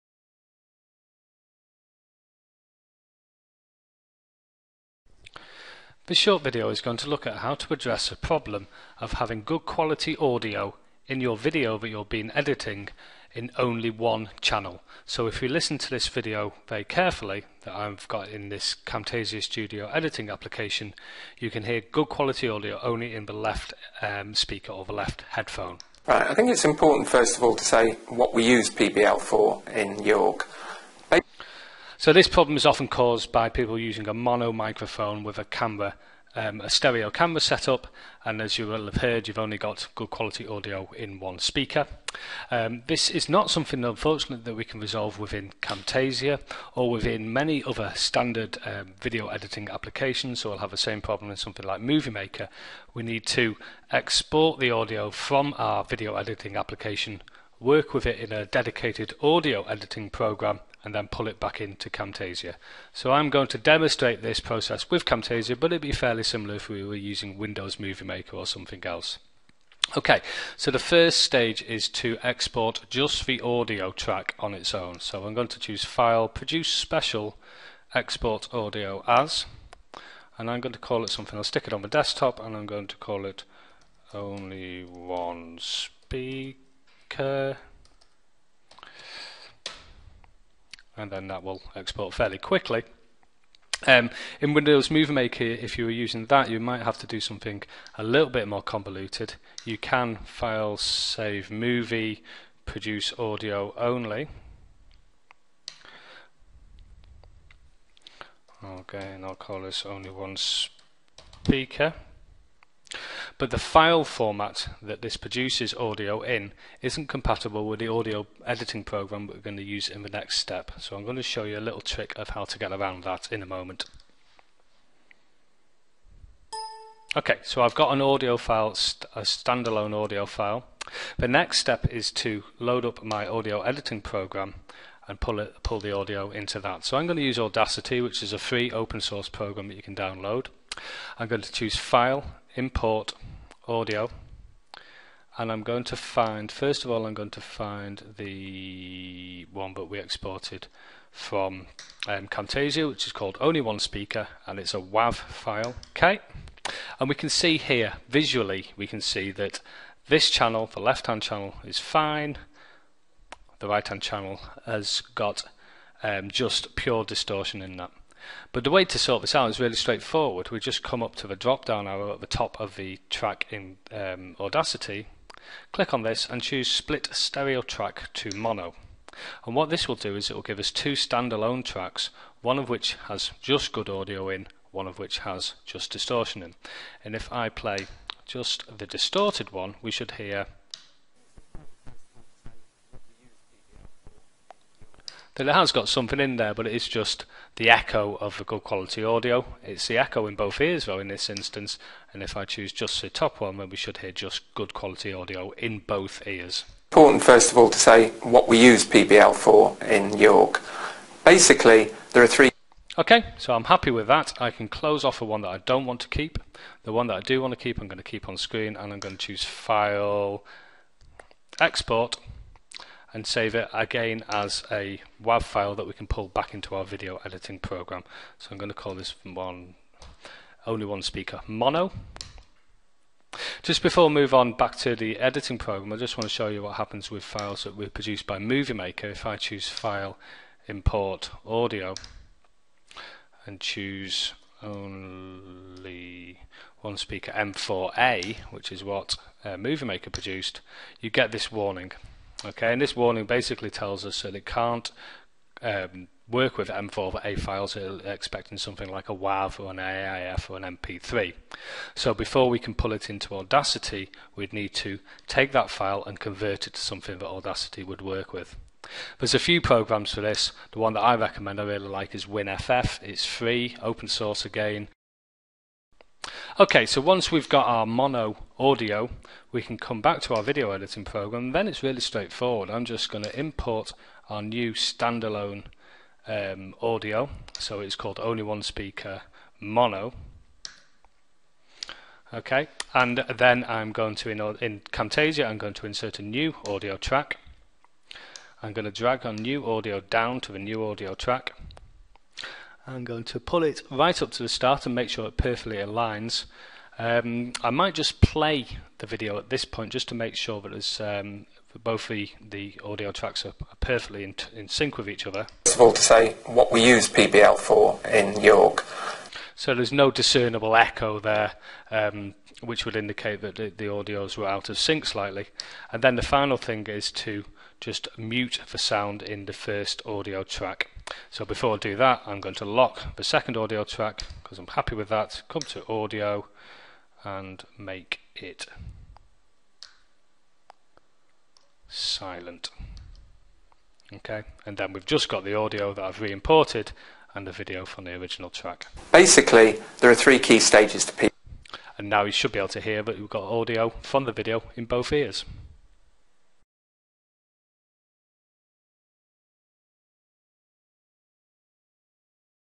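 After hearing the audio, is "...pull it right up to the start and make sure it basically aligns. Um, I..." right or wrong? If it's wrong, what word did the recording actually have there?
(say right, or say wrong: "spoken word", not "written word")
wrong: "perfectly", not "basically".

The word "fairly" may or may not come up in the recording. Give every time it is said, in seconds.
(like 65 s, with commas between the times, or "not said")
65 s, 92 s.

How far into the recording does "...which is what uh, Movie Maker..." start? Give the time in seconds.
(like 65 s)
248 s.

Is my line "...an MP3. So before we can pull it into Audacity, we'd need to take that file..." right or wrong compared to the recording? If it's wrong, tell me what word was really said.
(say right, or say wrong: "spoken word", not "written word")
right.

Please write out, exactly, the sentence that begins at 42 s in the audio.
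Um, this is not something, unfortunately, that we can resolve within Camtasia or within many other standard um, video editing applications.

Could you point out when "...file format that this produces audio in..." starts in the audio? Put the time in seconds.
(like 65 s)
113 s.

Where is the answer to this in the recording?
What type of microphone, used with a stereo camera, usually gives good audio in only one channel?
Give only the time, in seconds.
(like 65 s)
34 s.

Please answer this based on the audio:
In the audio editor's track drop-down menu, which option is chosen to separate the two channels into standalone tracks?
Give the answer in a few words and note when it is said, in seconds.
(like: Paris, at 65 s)
split stereo track to mono, at 176 s.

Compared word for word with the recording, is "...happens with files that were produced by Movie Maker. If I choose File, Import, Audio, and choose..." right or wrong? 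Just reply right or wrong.
right.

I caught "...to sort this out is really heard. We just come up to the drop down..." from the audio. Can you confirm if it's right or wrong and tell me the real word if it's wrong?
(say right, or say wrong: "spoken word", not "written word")
wrong: "straightforward", not "heard".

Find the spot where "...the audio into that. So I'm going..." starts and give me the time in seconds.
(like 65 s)
135 s.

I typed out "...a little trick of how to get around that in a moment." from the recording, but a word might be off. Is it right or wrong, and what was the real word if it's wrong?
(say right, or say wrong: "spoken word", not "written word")
right.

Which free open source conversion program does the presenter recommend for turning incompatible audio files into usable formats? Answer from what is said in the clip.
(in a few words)
WinFF.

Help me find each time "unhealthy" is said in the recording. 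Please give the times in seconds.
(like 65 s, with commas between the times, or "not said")
not said.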